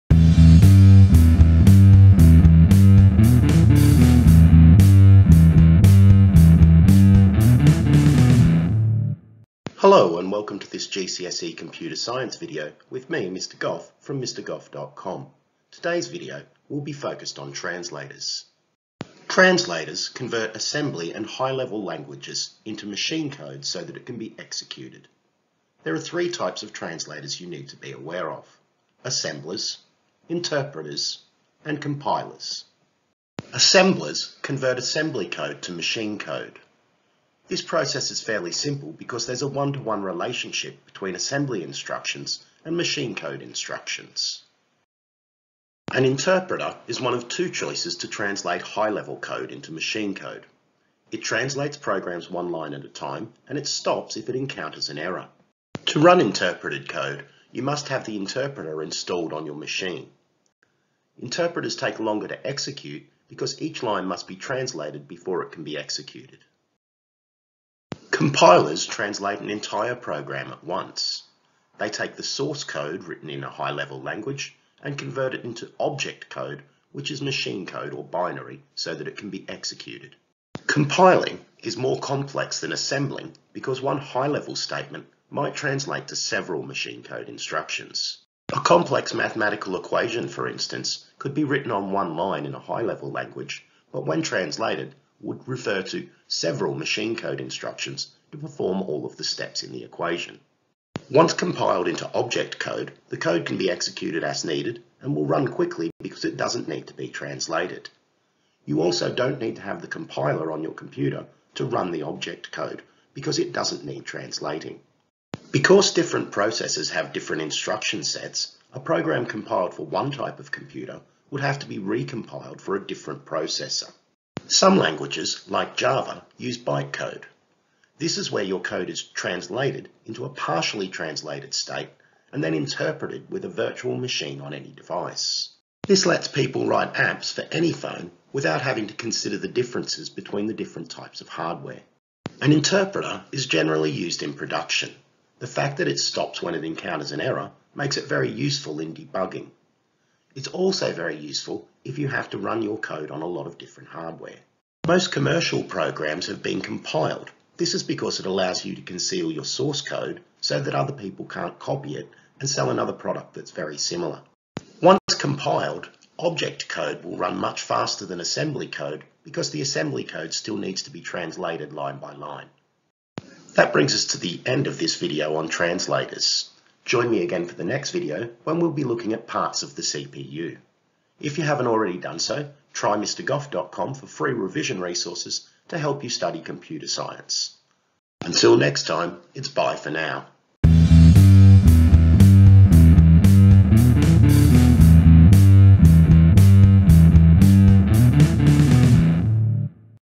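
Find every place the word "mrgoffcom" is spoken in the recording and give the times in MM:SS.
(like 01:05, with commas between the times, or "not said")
00:14, 03:02.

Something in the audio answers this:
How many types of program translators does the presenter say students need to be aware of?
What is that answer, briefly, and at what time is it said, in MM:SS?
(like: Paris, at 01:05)
3, at 00:25.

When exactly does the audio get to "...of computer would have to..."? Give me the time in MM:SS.
02:00.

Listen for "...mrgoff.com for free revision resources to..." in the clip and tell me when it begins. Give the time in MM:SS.
03:02.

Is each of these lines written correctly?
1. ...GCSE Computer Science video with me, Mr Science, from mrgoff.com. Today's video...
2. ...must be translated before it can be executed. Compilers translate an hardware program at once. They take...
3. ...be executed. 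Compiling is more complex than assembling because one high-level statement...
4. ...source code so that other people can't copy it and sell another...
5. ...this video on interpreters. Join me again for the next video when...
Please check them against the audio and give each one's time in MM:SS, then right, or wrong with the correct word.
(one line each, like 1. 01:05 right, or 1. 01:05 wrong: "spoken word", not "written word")
1. 00:10 wrong: "Goff", not "Science"
2. 01:04 wrong: "entire", not "hardware"
3. 01:19 right
4. 02:39 right
5. 02:54 wrong: "translators", not "interpreters".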